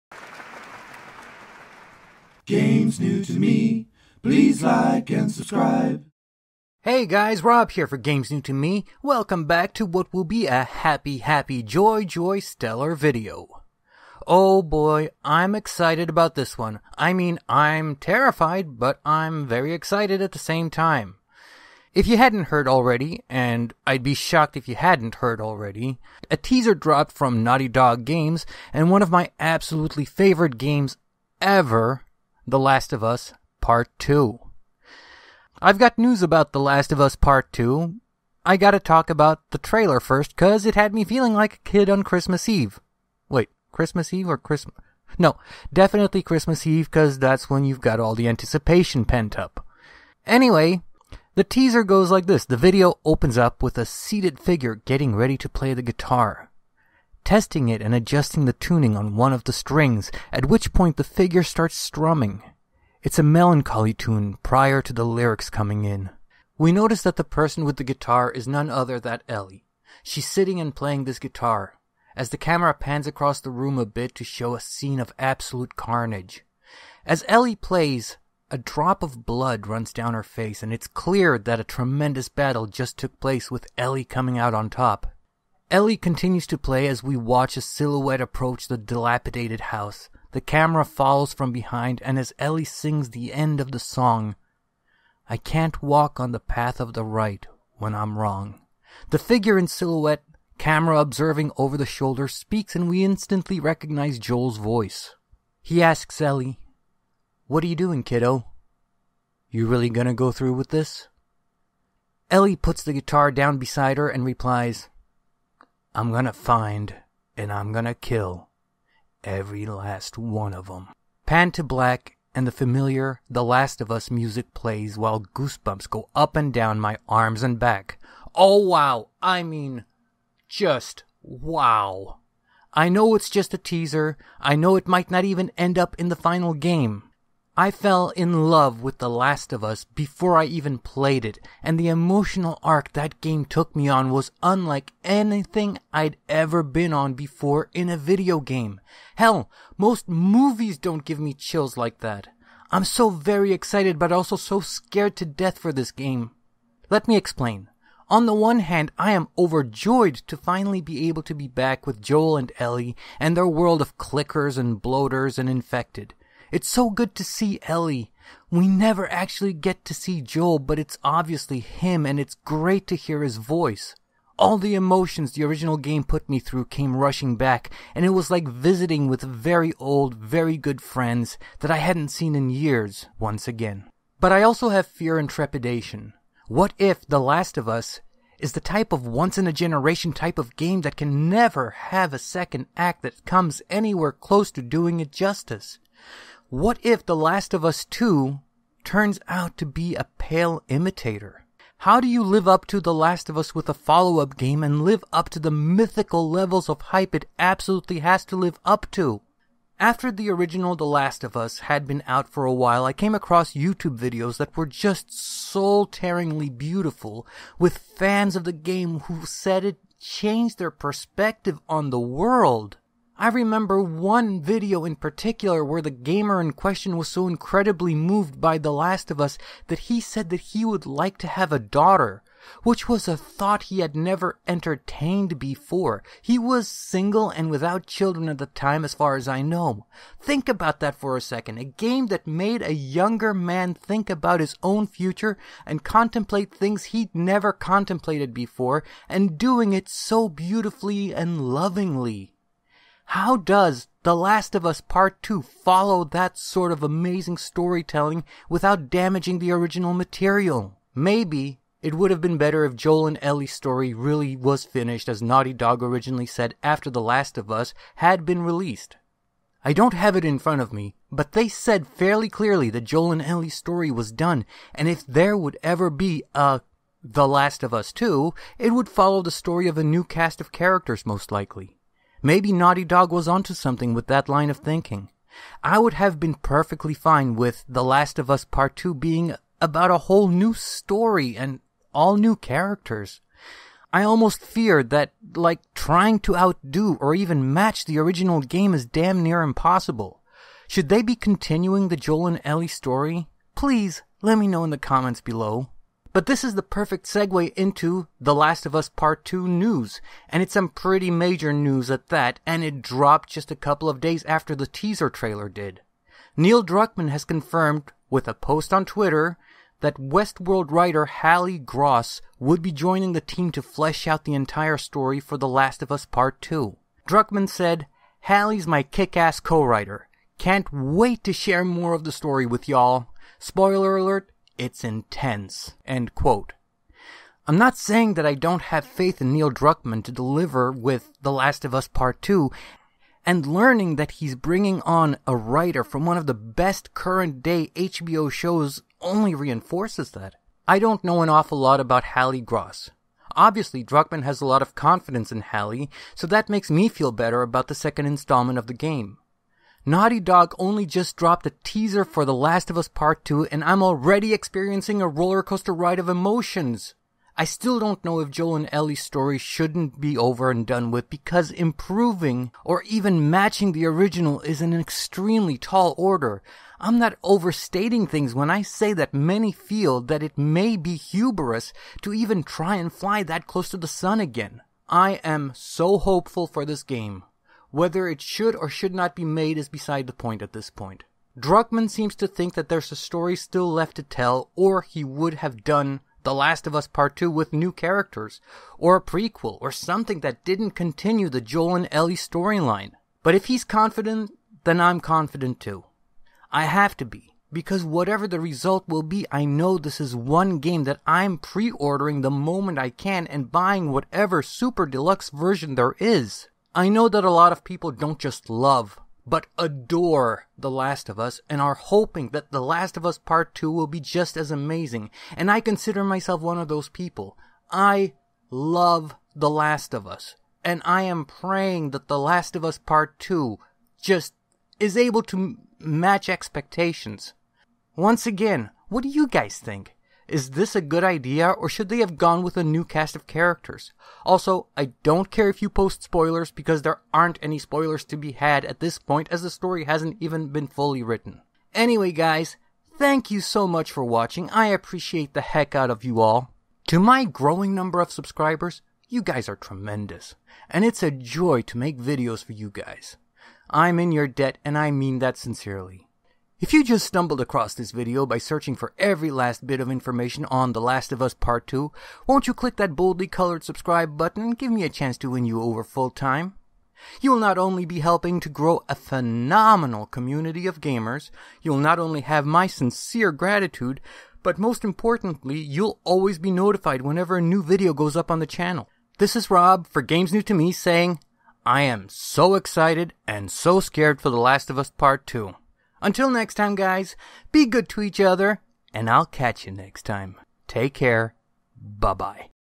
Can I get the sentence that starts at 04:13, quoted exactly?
How does The Last of Us Part 2 follow that sort of amazing storytelling without damaging the original material?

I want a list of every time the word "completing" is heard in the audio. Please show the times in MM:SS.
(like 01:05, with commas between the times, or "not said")
not said.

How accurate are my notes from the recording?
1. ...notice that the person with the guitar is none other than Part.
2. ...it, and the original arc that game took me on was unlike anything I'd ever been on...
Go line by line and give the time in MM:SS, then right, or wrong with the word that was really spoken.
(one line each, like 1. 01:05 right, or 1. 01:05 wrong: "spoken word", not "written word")
1. 01:06 wrong: "Ellie", not "Part"
2. 02:21 wrong: "emotional", not "original".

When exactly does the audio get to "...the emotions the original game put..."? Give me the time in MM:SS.
02:54.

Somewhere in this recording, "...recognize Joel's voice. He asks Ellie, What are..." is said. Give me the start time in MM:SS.
01:43.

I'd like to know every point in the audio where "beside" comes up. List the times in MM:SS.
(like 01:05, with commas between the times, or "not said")
01:53, 06:29.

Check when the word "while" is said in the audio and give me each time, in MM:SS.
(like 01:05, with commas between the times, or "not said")
02:04, 03:32.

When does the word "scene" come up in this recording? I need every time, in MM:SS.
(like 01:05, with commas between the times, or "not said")
01:14.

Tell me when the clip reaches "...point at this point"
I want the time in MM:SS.
06:30.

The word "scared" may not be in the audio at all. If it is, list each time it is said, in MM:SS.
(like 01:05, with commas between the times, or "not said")
02:34, 08:13.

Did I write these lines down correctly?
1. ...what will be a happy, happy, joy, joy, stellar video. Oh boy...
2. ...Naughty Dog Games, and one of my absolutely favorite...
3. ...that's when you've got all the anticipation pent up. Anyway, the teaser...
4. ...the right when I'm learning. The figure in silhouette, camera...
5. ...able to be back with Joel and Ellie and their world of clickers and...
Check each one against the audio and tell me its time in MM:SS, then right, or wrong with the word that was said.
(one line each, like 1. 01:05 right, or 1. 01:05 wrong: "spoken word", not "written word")
1. 00:09 right
2. 00:27 right
3. 00:47 right
4. 01:36 wrong: "wrong", not "learning"
5. 02:41 right.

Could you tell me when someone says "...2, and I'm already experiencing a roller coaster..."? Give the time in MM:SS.
06:03.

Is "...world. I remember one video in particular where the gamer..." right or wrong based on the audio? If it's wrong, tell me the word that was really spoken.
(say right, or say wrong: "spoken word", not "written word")
right.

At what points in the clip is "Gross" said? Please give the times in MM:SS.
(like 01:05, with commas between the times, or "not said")
05:21, 05:52.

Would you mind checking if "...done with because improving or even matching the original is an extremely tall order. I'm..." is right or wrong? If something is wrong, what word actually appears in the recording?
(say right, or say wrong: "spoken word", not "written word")
right.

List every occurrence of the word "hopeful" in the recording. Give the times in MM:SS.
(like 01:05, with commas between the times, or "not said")
06:25.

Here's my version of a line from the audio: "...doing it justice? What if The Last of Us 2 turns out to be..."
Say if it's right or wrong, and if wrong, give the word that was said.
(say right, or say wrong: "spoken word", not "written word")
right.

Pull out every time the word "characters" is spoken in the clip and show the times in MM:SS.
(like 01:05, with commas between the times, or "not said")
04:40, 04:52, 06:37, 07:23.